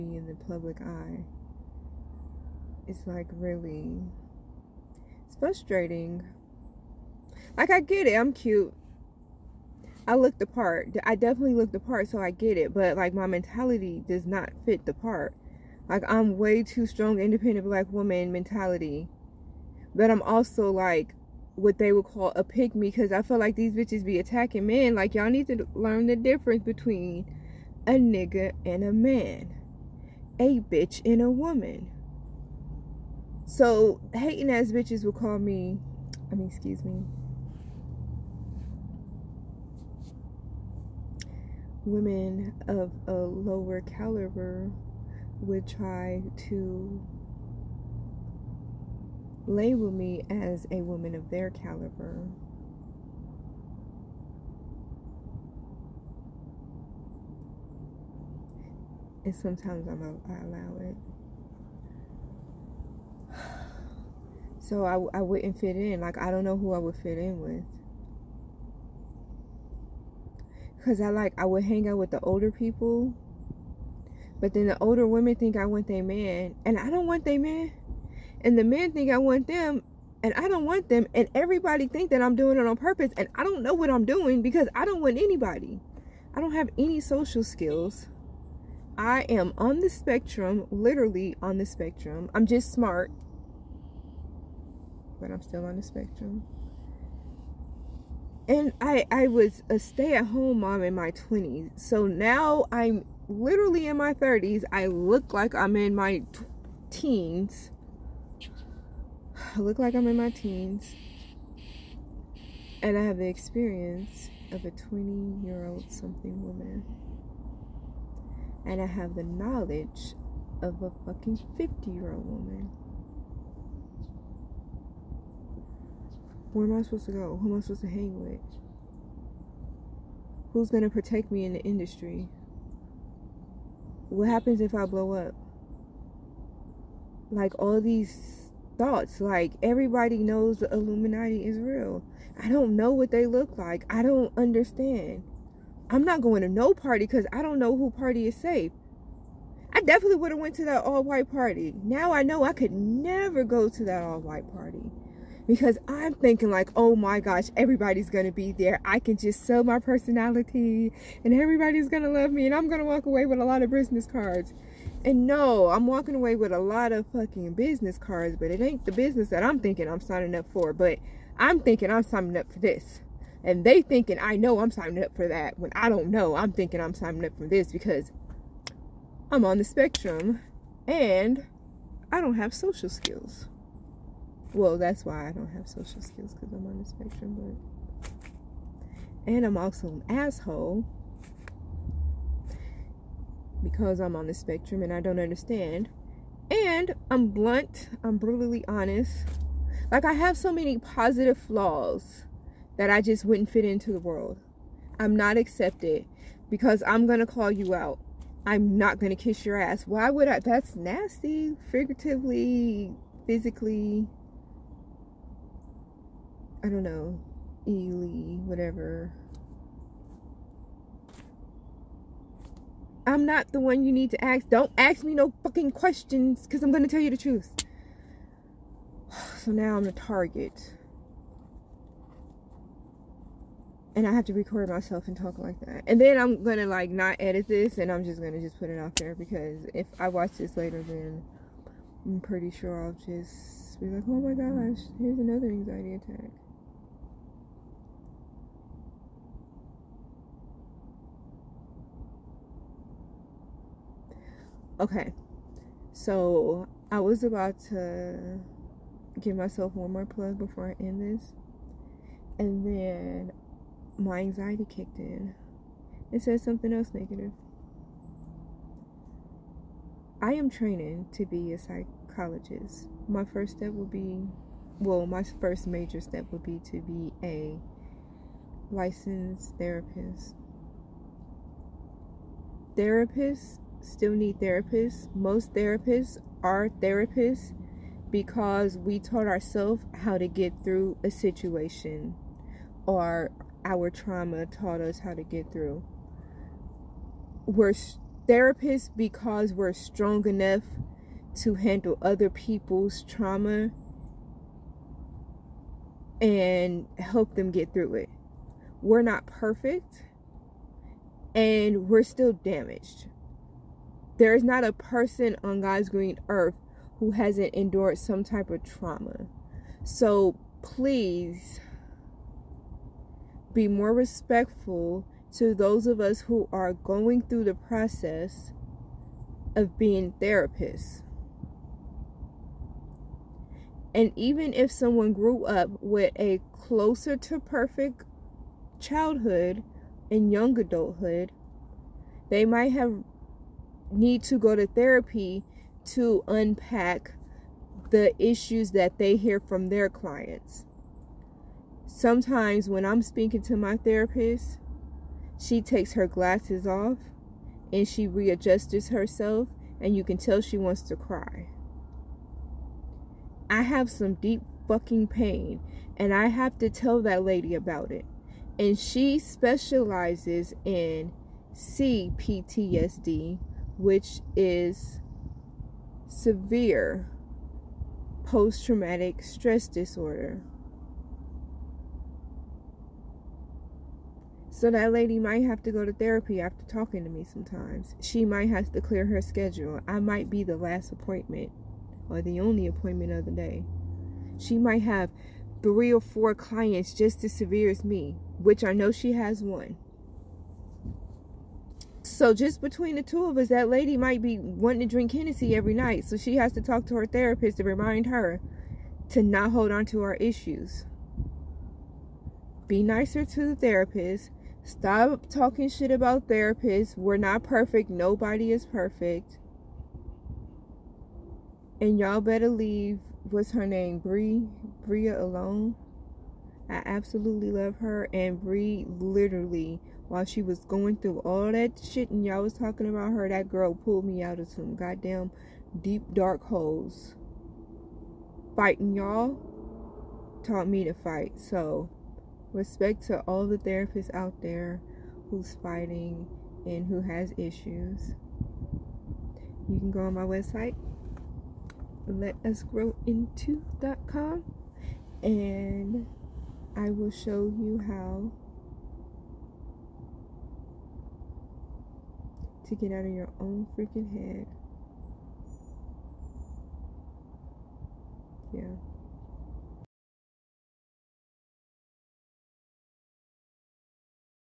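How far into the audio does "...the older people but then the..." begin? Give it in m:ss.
1:12.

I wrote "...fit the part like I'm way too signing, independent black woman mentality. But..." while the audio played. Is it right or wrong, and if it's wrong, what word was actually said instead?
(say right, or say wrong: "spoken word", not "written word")
wrong: "strong", not "signing".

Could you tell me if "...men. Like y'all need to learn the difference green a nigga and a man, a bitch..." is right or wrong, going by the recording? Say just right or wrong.
wrong.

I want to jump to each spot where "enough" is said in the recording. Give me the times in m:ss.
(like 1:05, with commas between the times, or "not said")
5:00.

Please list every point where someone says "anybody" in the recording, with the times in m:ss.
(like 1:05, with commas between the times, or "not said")
1:25.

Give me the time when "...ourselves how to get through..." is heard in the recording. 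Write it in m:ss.
4:49.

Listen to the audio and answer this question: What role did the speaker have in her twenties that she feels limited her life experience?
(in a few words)
stay-at-home mom.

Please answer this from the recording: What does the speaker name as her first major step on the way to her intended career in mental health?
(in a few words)
licensed therapist.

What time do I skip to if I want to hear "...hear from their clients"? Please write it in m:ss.
5:49.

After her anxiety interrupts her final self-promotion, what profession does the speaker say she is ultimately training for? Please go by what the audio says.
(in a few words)
psychologist.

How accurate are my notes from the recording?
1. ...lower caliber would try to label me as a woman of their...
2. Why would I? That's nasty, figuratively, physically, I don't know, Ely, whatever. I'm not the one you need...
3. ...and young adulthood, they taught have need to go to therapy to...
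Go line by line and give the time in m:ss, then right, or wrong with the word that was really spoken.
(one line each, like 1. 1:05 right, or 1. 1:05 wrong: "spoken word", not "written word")
1. 0:43 right
2. 3:29 right
3. 5:40 wrong: "might", not "taught".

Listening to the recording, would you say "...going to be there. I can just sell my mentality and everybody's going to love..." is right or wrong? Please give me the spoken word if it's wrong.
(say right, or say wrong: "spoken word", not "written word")
wrong: "personality", not "mentality".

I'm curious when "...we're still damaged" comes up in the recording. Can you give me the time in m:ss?
5:11.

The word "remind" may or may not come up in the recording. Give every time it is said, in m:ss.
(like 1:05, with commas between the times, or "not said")
6:47.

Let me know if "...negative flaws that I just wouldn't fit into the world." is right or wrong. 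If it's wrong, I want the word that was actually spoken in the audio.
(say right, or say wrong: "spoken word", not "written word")
wrong: "positive", not "negative".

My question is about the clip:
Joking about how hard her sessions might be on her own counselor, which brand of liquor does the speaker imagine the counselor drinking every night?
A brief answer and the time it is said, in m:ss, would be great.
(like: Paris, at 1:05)
Hennessy, at 6:45.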